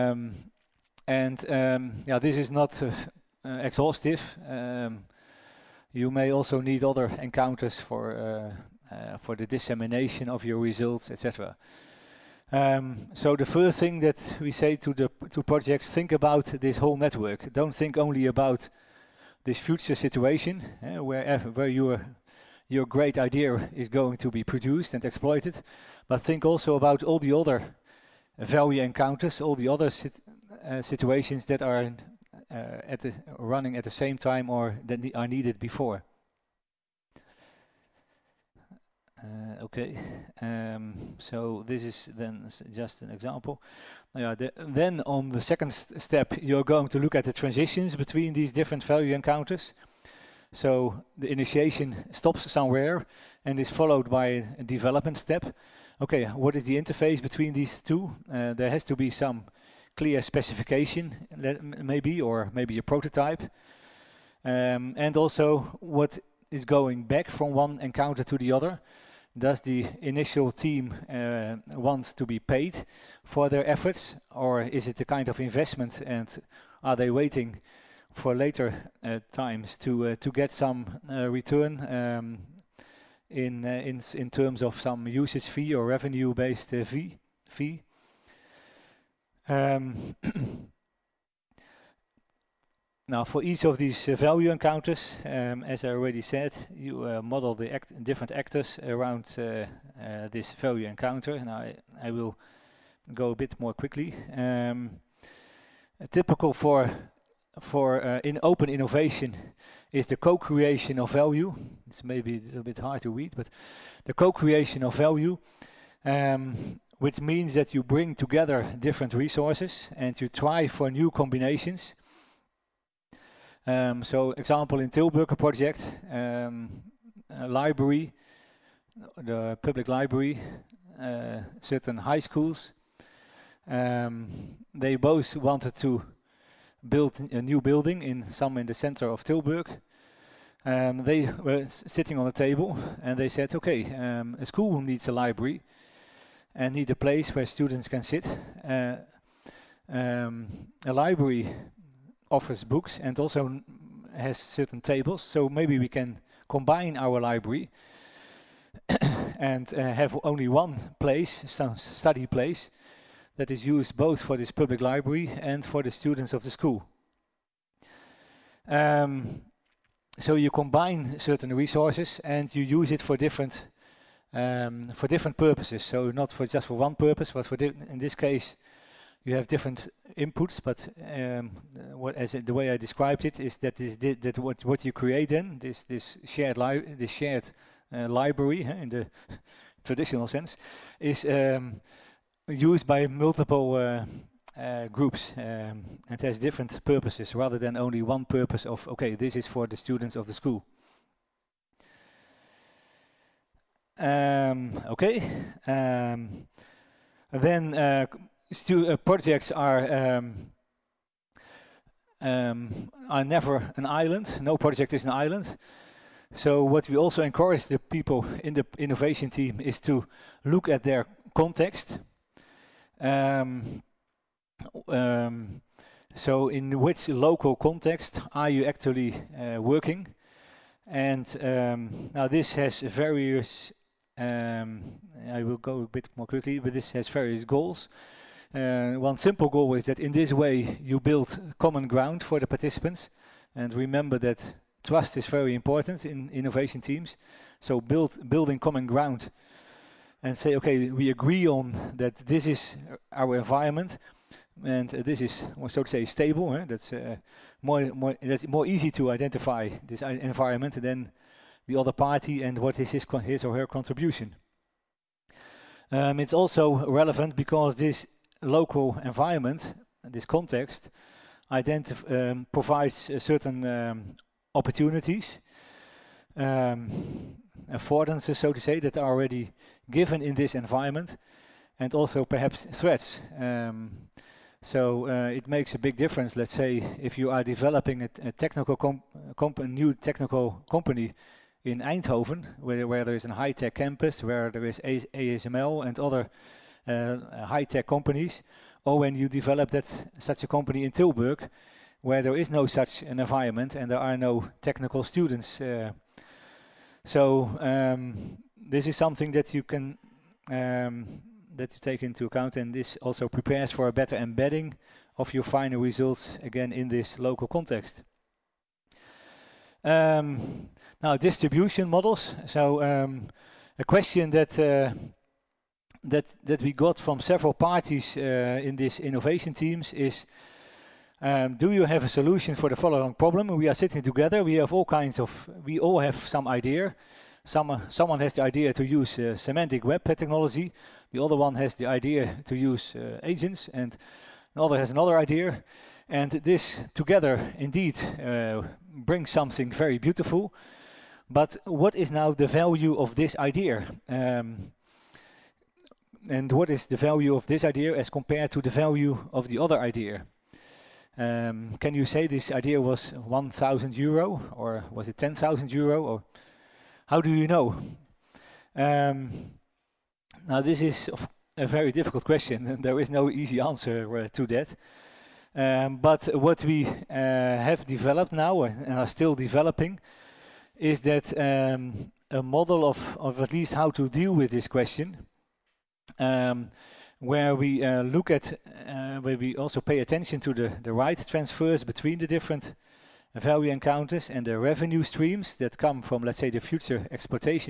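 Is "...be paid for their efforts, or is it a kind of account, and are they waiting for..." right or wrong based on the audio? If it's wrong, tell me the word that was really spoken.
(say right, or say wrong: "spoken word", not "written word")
wrong: "investment", not "account".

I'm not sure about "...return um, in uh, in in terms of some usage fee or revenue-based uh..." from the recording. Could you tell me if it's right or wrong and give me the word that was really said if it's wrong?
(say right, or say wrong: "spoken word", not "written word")
right.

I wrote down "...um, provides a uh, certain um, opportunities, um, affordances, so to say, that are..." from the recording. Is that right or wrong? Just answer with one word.
right.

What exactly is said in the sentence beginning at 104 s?
Um, typical for for uh, in open innovation is the co-creation of value.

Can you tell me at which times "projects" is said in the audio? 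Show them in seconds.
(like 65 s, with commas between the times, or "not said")
15 s, 125 s, 208 s, 214 s.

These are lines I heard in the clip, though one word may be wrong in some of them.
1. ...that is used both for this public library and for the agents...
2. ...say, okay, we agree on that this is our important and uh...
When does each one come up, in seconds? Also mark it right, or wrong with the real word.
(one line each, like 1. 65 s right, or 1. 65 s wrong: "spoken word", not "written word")
1. 163 s wrong: "students", not "agents"
2. 250 s wrong: "environment", not "important".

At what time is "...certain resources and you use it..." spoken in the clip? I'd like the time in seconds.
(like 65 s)
171 s.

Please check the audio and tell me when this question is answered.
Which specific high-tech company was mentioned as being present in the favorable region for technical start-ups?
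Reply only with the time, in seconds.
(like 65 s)
295 s.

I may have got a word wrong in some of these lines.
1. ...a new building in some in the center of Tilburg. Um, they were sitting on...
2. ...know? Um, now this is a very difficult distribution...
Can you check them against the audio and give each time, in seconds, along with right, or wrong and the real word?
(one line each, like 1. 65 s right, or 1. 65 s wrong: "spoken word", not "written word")
1. 137 s right
2. 367 s wrong: "question", not "distribution".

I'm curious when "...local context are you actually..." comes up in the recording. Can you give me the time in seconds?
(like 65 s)
227 s.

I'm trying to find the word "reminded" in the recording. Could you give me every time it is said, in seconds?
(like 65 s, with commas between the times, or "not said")
not said.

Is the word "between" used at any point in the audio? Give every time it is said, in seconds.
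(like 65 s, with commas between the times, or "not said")
47 s, 57 s, 391 s.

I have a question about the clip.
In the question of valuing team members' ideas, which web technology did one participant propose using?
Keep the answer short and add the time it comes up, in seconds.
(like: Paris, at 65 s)
Semantic web technology, at 339 s.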